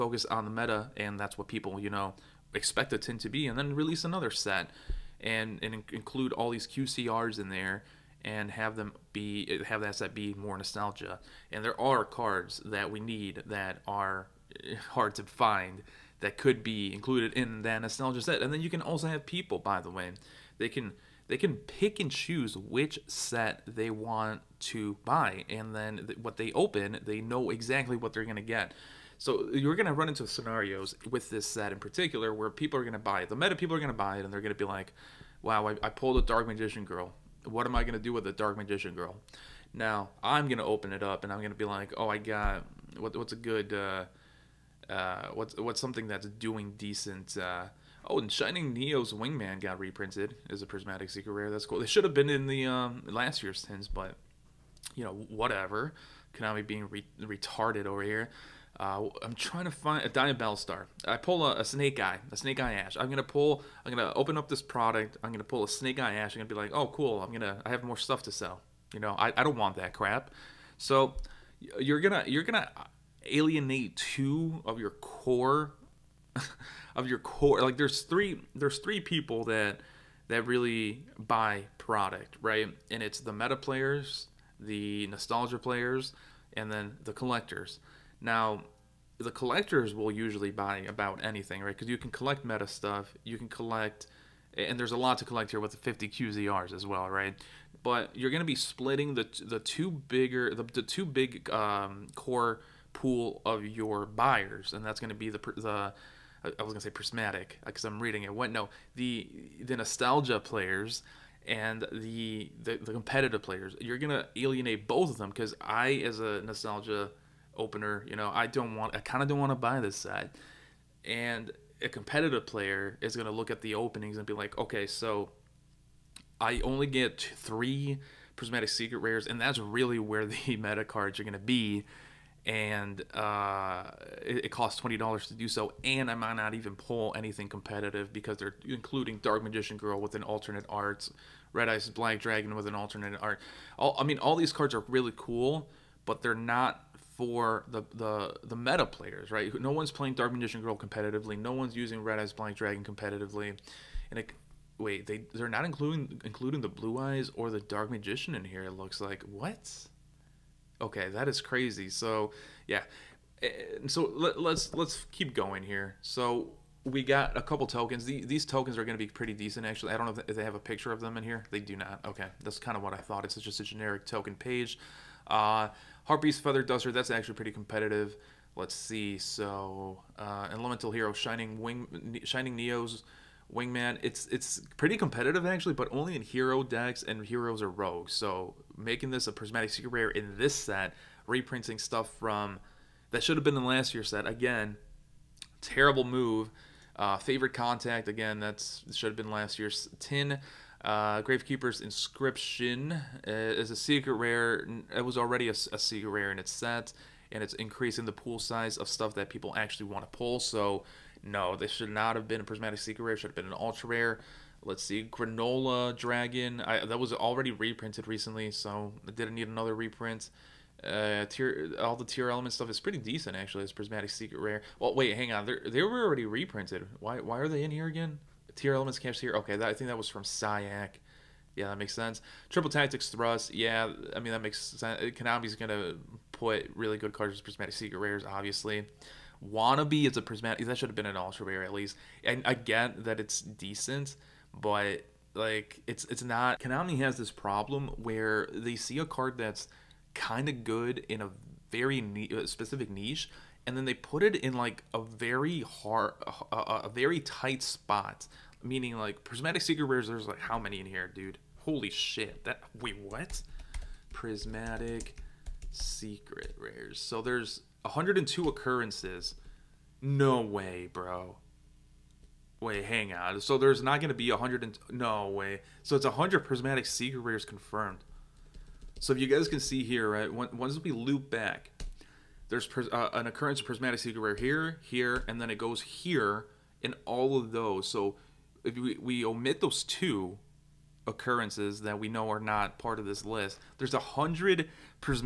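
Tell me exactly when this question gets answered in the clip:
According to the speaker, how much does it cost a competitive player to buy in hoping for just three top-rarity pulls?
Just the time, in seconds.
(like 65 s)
134 s.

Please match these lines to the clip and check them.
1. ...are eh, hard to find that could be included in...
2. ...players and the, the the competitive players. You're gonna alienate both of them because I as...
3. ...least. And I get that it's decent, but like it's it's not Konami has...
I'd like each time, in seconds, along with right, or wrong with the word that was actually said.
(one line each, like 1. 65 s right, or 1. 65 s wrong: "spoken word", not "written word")
1. 13 s right
2. 110 s right
3. 241 s right.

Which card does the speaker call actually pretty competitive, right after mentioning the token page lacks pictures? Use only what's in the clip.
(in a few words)
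Harpy's Feather Duster.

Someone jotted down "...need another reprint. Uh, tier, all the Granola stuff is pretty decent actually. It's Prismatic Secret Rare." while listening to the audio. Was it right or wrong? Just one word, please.
wrong.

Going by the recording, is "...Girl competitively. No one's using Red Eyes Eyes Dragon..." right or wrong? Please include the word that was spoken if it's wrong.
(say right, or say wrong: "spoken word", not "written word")
wrong: "Black", not "Eyes".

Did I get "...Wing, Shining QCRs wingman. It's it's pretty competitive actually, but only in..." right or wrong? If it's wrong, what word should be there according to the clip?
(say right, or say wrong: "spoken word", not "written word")
wrong: "Neos", not "QCRs".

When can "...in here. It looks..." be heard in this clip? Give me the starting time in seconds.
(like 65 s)
158 s.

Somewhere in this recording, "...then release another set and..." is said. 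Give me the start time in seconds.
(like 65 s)
3 s.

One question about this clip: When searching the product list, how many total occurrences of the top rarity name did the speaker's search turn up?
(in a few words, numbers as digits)
102.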